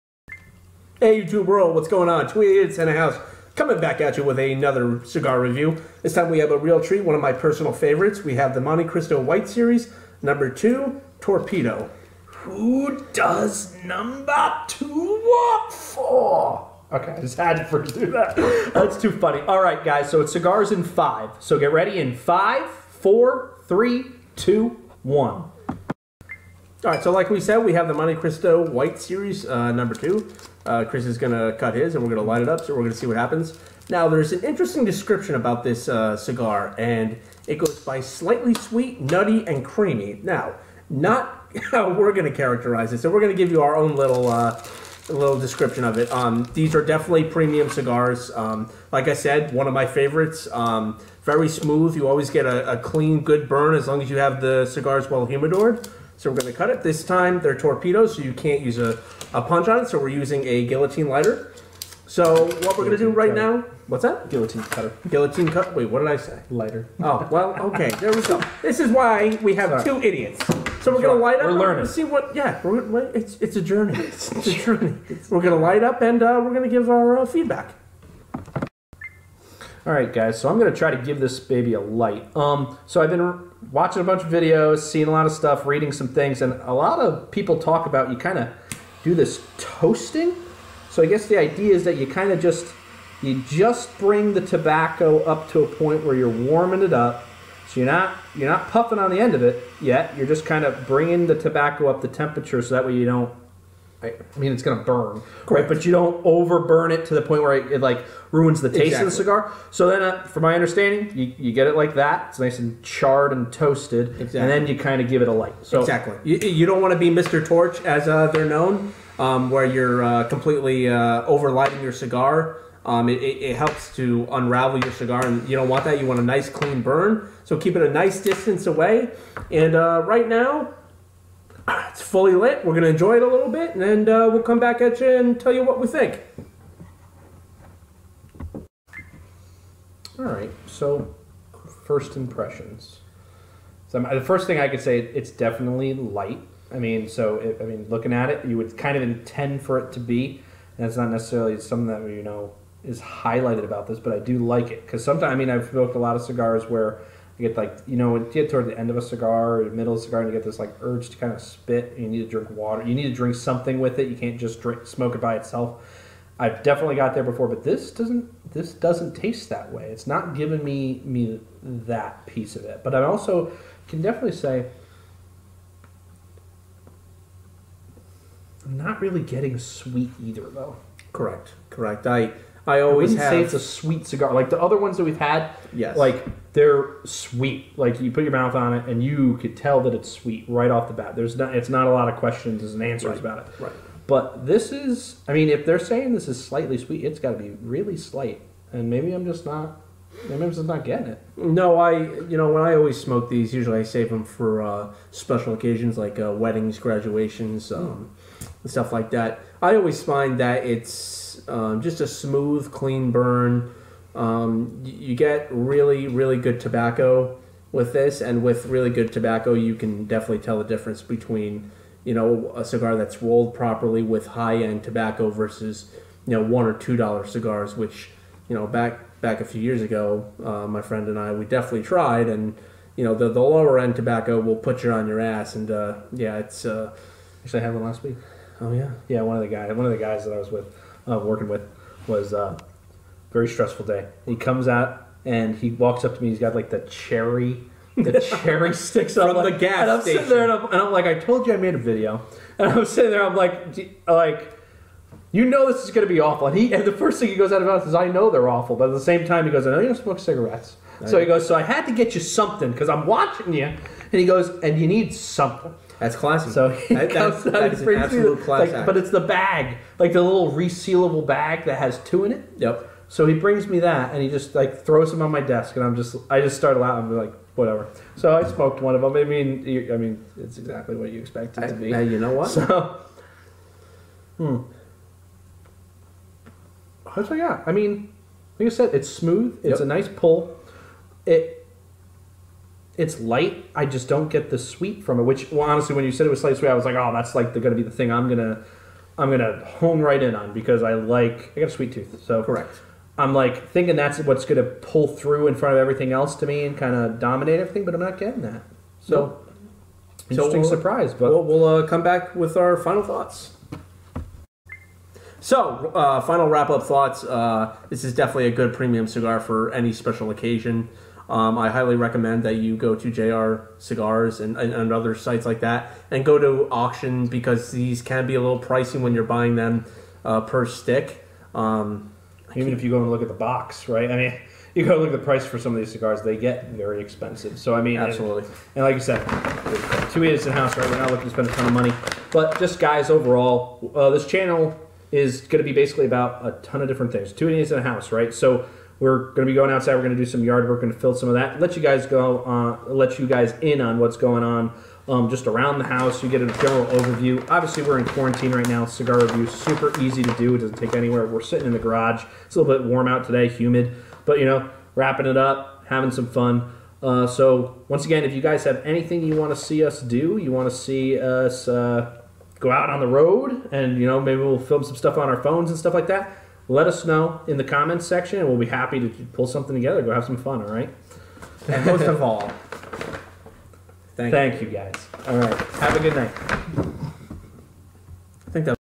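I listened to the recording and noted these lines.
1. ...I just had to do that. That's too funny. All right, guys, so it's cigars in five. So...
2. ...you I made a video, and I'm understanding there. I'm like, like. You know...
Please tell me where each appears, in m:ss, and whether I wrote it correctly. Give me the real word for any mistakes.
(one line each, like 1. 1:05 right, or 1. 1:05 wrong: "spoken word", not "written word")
1. 0:17 right
2. 4:11 wrong: "sitting", not "understanding".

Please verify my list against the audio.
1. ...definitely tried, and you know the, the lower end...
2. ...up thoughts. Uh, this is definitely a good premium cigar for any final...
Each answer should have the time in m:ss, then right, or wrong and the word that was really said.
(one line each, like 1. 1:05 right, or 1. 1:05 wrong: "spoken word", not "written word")
1. 3:51 right
2. 5:16 wrong: "special", not "final".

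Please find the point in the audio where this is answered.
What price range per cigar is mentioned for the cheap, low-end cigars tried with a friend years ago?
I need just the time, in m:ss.
3:46.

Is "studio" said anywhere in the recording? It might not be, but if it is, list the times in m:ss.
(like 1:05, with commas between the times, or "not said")
not said.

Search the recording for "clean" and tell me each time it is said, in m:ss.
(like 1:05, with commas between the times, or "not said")
0:52, 2:06, 3:32.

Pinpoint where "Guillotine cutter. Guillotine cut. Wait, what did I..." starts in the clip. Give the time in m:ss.
1:04.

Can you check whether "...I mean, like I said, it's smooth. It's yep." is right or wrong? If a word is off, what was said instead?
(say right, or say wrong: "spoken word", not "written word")
right.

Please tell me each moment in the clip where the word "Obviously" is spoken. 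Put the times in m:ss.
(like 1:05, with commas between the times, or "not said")
5:57.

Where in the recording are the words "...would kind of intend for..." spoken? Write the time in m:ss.
2:28.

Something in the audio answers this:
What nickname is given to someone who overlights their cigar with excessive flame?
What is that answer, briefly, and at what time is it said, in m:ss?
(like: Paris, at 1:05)
Mr. Torch, at 1:57.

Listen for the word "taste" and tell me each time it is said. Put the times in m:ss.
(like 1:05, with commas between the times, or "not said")
1:48, 2:49.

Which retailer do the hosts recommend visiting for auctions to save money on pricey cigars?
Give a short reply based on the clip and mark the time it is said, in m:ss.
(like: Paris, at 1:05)
JR Cigars, at 5:23.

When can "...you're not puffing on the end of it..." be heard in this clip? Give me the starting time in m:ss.
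1:38.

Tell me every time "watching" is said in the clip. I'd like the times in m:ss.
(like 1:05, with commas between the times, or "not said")
1:23, 4:23.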